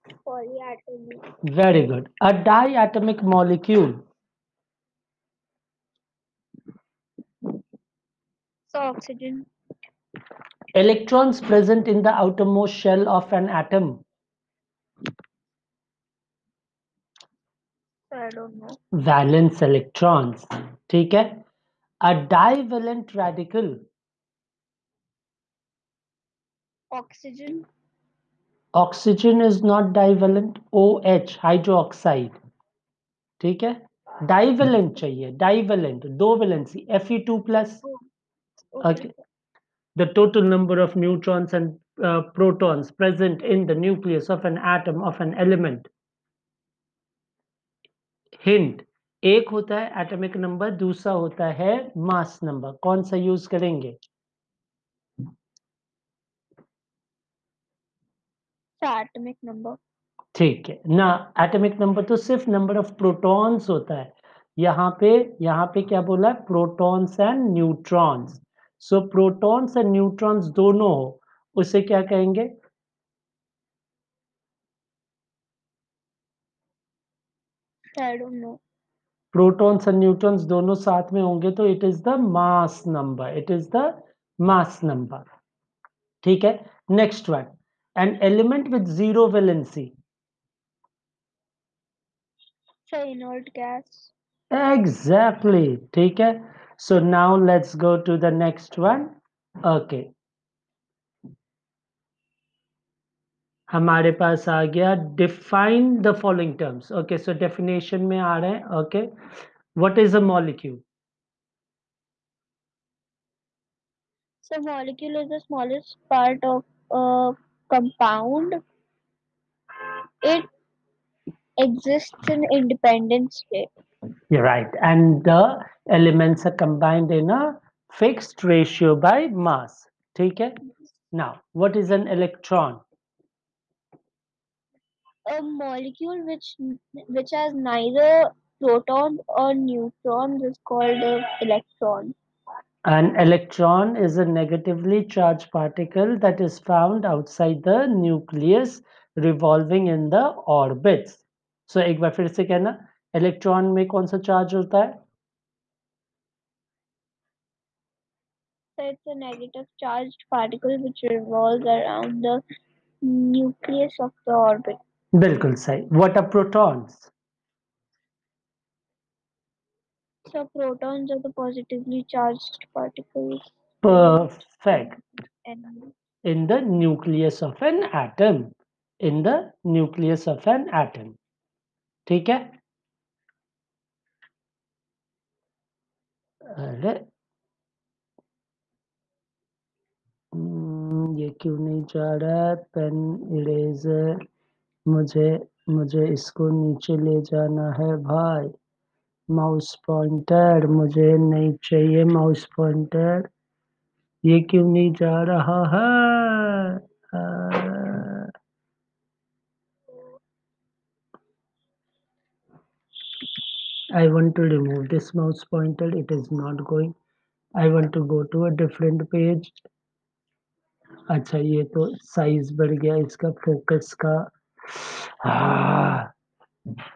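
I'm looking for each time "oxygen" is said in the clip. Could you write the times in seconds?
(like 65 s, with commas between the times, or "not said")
8 s, 26 s.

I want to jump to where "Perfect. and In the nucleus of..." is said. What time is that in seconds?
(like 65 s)
173 s.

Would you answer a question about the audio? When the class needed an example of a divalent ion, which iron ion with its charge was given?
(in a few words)
Fe2+.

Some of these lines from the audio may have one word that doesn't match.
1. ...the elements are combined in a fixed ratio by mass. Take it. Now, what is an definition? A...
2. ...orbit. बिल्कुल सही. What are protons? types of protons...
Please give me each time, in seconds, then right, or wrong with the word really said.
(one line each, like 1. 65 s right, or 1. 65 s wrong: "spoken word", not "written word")
1. 125 s wrong: "electron", not "definition"
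2. 164 s right.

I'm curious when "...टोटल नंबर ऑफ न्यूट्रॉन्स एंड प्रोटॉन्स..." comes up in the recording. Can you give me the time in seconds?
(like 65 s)
40 s.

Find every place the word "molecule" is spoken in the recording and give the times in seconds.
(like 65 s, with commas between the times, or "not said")
3 s, 110 s, 114 s, 135 s.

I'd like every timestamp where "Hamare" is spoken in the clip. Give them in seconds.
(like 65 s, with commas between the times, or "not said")
103 s.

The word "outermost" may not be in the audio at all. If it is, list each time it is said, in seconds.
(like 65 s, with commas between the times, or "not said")
12 s.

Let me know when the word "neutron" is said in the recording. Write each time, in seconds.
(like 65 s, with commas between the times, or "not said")
139 s.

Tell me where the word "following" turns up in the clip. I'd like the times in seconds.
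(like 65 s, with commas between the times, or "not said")
106 s.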